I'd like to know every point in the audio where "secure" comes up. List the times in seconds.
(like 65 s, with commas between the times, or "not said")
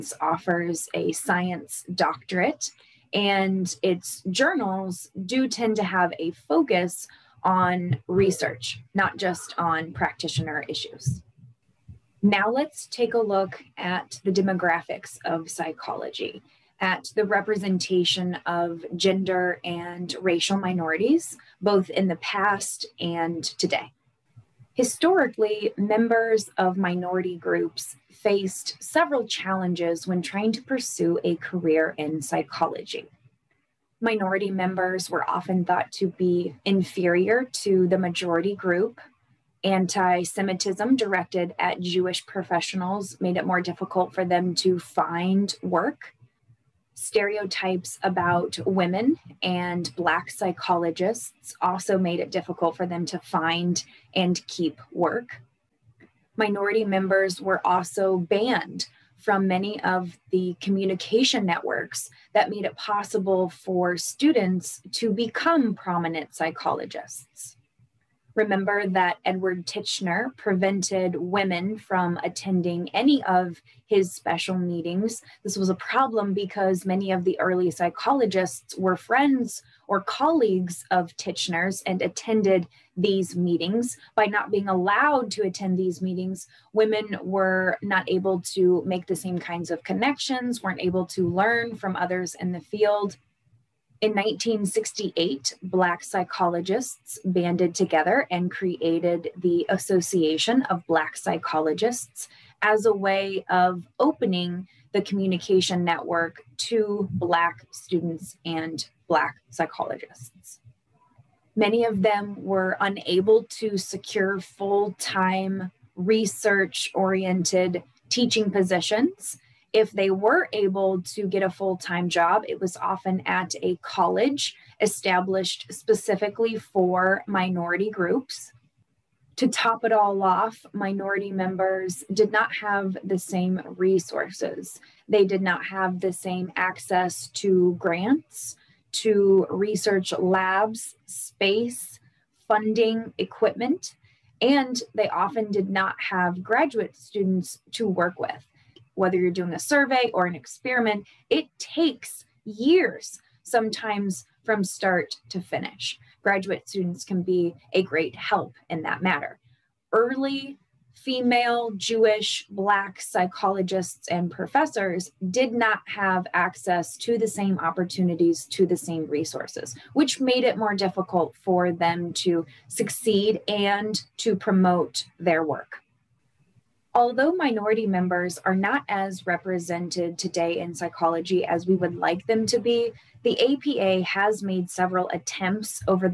113 s.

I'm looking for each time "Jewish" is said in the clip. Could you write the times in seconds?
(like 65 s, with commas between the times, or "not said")
41 s, 161 s.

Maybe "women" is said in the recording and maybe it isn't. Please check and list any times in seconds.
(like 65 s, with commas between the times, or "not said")
48 s, 71 s, 86 s.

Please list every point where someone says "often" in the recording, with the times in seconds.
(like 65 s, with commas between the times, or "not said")
35 s, 122 s, 145 s.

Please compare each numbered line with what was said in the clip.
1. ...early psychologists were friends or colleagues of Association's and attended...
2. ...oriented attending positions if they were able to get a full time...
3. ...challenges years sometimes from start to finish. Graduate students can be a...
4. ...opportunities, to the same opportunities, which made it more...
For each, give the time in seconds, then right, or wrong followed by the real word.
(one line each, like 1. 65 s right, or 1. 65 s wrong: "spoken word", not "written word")
1. 77 s wrong: "Titchener", not "Association"
2. 116 s wrong: "teaching", not "attending"
3. 151 s wrong: "takes", not "challenges"
4. 167 s wrong: "resources", not "opportunities".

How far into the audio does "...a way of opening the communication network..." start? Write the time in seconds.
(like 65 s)
102 s.